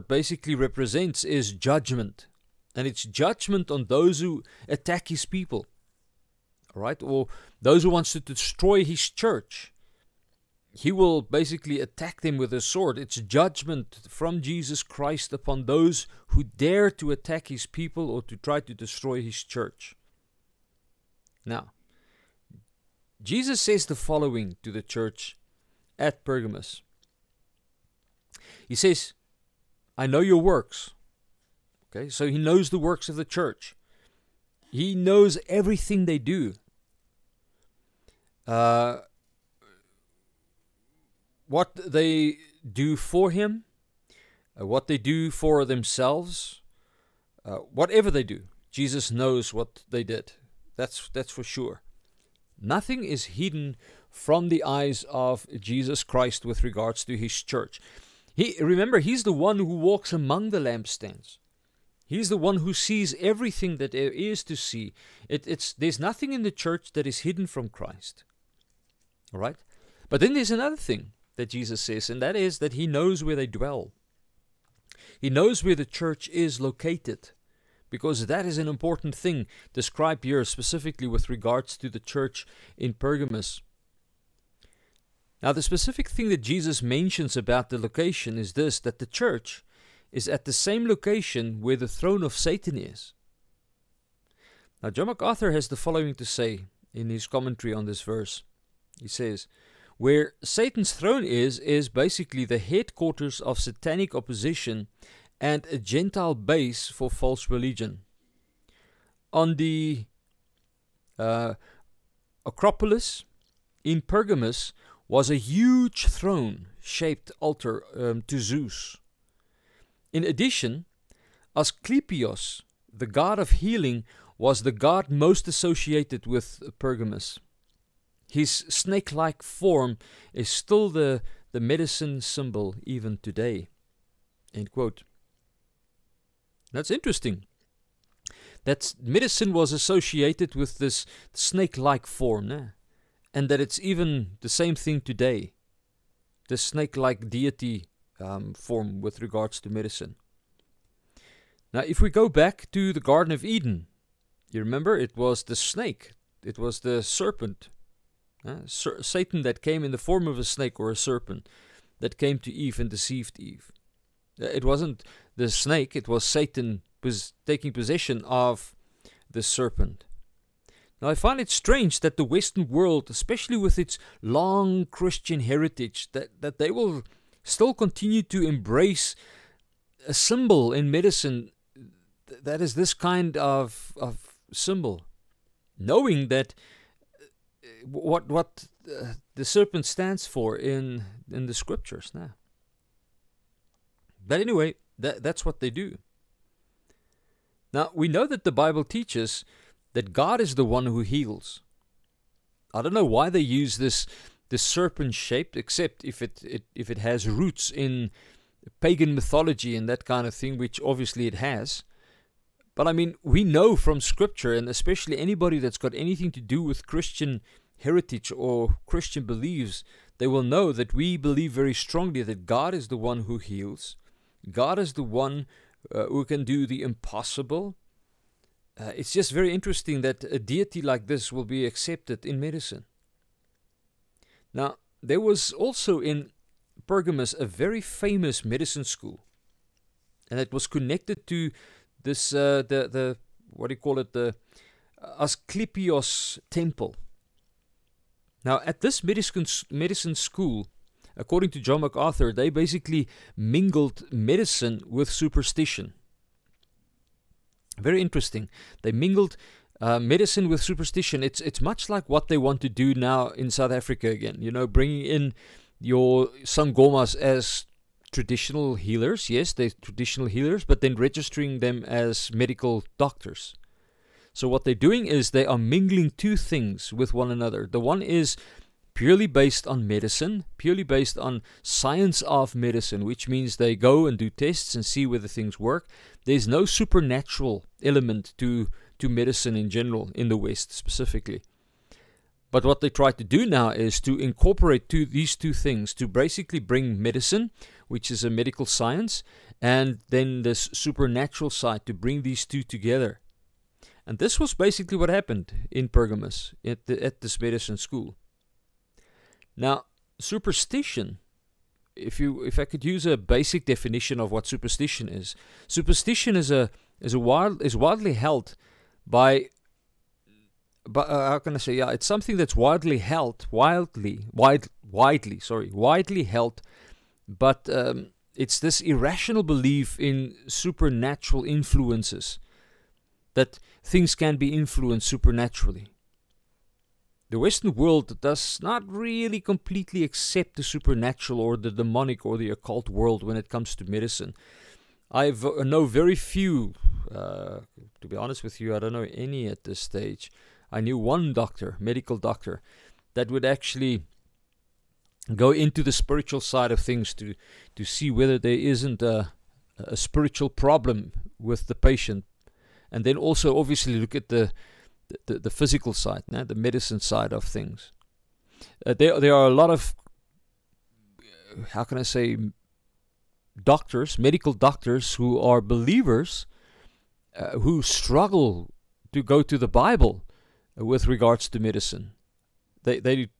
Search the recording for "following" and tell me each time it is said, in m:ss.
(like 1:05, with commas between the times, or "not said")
0:23, 1:35.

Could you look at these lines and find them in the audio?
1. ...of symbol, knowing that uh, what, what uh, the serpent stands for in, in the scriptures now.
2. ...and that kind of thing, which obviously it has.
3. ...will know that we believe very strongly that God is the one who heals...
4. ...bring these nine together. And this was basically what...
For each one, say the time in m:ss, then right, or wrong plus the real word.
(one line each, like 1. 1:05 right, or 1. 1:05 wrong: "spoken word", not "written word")
1. 3:04 right
2. 3:29 right
3. 3:40 right
4. 5:01 wrong: "two", not "nine".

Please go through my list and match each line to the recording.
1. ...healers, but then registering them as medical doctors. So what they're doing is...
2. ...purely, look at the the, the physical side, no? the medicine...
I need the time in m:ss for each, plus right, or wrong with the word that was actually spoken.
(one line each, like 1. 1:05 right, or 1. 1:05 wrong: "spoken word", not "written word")
1. 4:30 right
2. 6:03 wrong: "obviously", not "purely".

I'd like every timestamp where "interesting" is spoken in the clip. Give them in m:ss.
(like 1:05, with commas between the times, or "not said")
2:16, 3:49, 4:18.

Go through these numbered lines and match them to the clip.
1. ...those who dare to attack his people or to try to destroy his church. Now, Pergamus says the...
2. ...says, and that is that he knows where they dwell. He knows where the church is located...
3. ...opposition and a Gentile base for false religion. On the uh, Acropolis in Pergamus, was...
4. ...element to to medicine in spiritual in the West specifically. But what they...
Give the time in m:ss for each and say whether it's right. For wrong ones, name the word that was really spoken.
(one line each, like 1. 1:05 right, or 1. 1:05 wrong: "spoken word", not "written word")
1. 0:15 wrong: "Jesus", not "Pergamus"
2. 1:11 right
3. 1:44 right
4. 4:47 wrong: "general", not "spiritual".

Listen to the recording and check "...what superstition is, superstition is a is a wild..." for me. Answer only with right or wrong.
right.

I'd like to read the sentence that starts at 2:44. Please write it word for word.
Uh, it wasn't the snake, it was Satan was taking possession of the serpent.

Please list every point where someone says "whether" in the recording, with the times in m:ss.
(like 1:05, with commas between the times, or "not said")
4:45, 5:58.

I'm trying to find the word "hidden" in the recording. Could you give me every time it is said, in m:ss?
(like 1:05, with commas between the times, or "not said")
0:53, 1:07.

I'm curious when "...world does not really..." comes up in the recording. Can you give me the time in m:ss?
5:37.